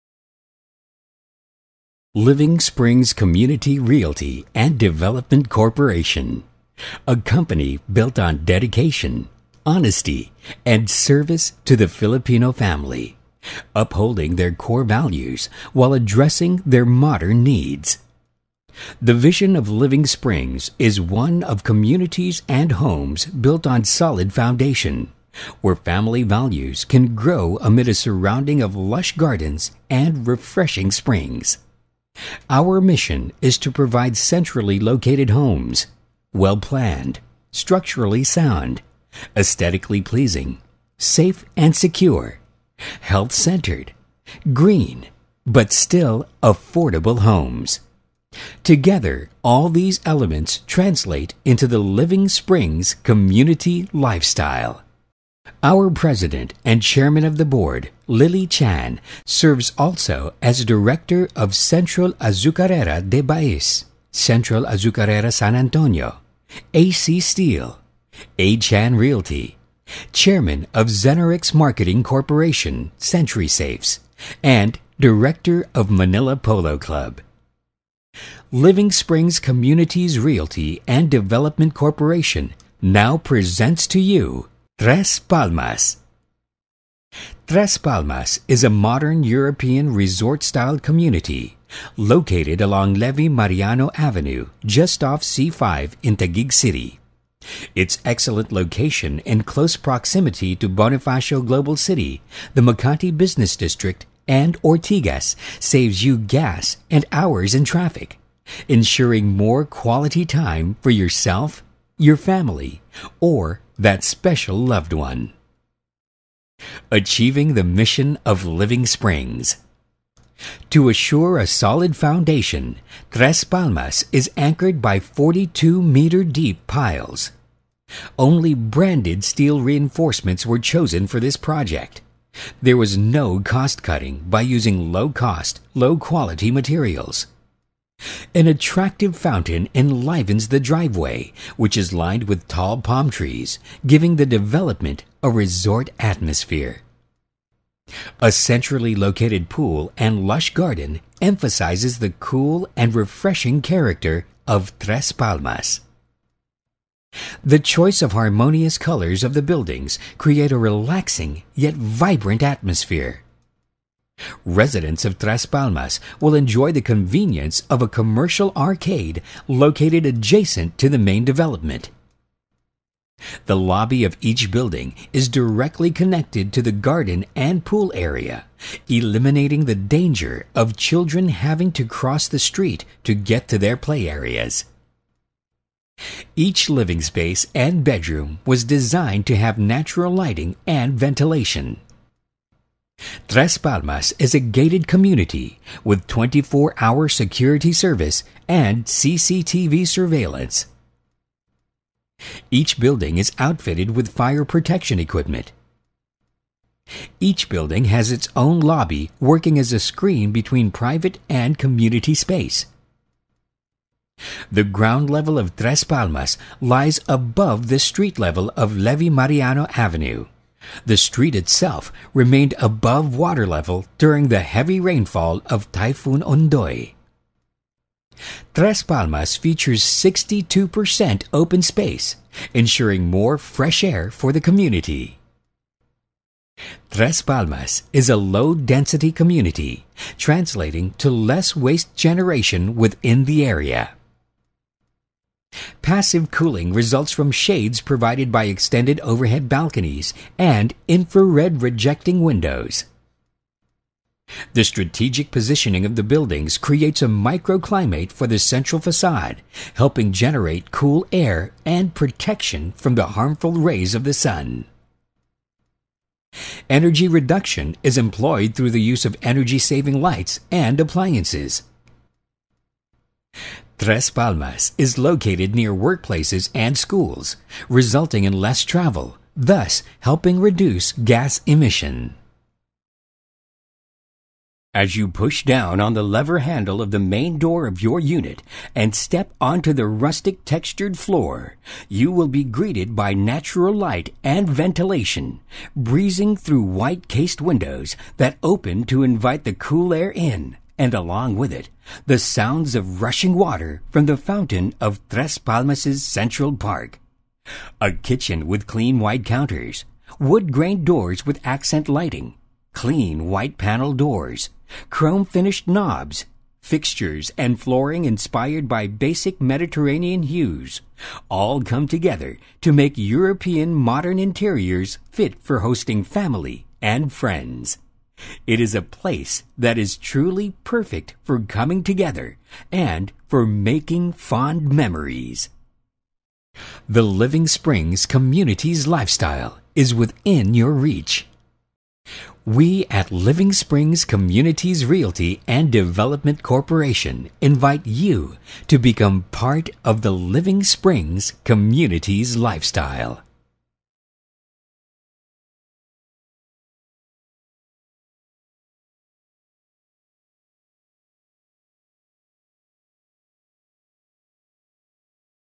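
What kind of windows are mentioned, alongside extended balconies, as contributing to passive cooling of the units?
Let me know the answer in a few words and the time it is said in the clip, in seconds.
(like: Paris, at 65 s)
infrared rejecting windows, at 250 s.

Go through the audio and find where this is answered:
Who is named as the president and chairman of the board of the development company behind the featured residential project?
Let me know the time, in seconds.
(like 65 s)
58 s.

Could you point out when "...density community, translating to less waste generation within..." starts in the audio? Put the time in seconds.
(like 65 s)
238 s.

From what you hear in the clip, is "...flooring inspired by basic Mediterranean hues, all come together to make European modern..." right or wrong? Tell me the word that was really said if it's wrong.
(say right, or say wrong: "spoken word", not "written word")
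right.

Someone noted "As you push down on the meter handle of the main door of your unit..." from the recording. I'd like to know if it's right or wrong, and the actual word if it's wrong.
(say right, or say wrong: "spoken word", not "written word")
wrong: "lever", not "meter".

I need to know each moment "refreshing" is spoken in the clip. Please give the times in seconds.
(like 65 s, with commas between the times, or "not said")
30 s, 152 s.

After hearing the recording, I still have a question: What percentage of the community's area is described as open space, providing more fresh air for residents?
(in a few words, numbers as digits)
62%.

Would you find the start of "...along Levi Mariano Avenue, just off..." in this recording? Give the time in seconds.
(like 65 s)
92 s.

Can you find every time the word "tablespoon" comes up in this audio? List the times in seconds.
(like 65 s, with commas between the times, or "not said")
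not said.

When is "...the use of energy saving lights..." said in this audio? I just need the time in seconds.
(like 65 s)
268 s.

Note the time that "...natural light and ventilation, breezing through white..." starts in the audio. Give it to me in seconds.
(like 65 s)
293 s.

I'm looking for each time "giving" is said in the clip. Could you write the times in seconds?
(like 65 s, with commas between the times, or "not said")
143 s.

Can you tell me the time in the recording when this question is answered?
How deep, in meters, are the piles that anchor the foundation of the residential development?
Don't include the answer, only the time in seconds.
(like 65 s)
124 s.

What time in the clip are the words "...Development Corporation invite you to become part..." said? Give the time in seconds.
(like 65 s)
345 s.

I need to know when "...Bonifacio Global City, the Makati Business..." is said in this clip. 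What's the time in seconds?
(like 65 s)
100 s.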